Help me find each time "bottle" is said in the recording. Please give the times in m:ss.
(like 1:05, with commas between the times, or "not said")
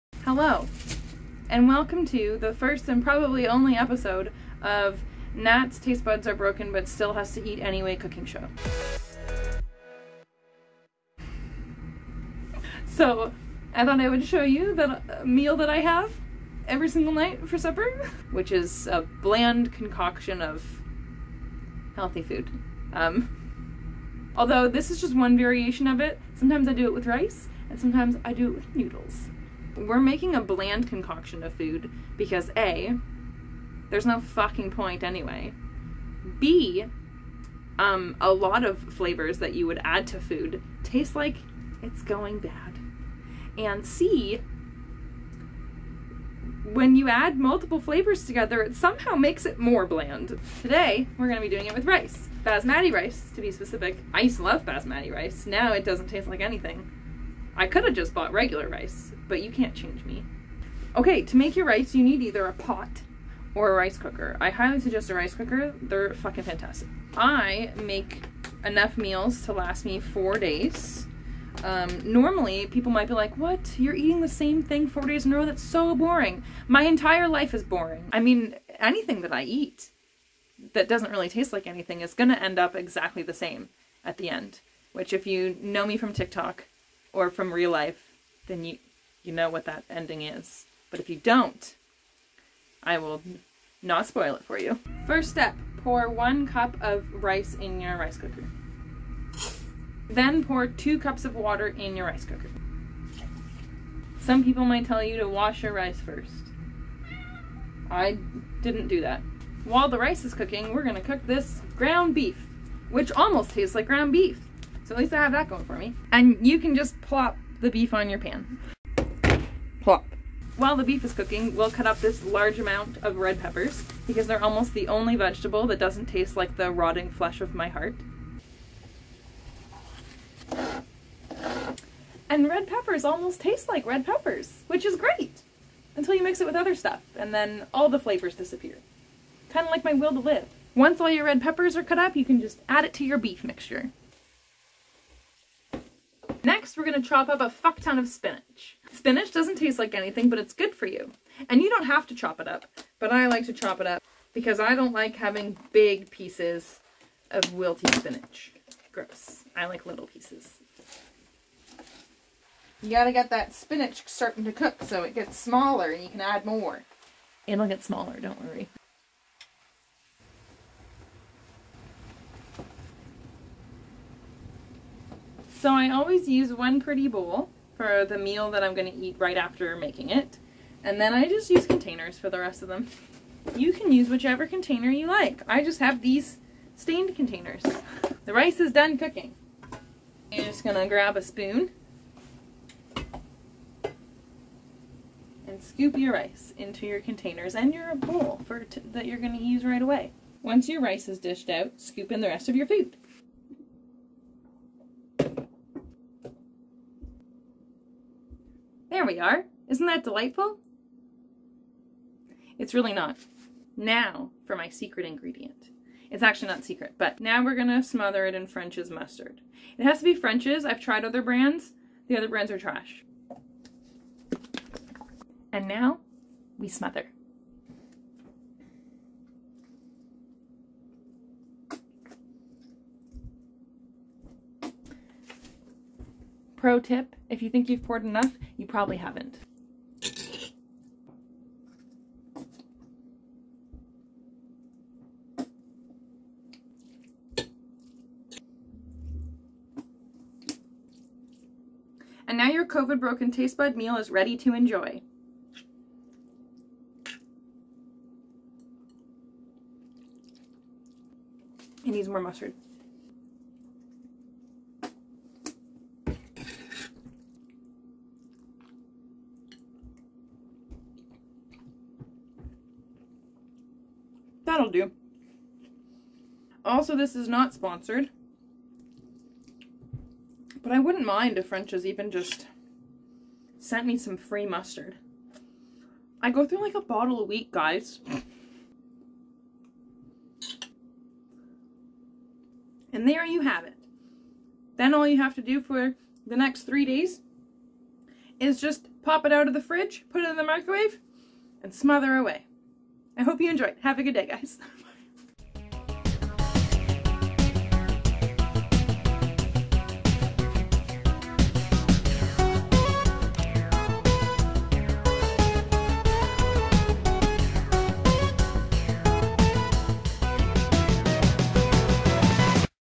4:46.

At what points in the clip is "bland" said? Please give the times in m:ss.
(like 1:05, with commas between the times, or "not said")
0:19, 0:30, 0:49.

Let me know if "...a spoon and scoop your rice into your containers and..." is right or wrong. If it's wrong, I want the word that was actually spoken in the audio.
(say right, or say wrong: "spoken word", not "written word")
right.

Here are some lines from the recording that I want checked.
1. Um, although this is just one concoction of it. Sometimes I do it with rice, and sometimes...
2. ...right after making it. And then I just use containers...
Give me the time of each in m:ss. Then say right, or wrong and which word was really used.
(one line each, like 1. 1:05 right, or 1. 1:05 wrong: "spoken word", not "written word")
1. 0:22 wrong: "variation", not "concoction"
2. 2:59 right.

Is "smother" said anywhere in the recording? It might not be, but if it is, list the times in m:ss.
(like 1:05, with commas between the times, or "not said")
3:37, 3:46, 5:01.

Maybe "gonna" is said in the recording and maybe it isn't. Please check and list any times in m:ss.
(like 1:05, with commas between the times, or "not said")
0:51, 1:50, 3:37.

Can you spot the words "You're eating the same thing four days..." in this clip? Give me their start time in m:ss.
1:13.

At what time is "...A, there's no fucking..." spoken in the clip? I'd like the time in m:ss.
0:32.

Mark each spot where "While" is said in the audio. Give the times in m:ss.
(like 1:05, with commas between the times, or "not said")
1:49, 2:00.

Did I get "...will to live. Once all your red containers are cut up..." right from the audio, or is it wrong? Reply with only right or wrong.
wrong.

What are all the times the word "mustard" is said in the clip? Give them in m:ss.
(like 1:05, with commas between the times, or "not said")
3:38, 4:22, 4:44.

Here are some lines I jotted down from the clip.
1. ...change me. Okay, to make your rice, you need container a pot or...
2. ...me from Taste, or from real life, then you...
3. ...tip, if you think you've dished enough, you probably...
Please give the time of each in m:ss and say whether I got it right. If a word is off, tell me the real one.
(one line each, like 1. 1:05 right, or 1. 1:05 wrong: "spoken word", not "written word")
1. 0:59 wrong: "either", not "container"
2. 1:25 wrong: "TikTok", not "Taste"
3. 3:56 wrong: "poured", not "dished".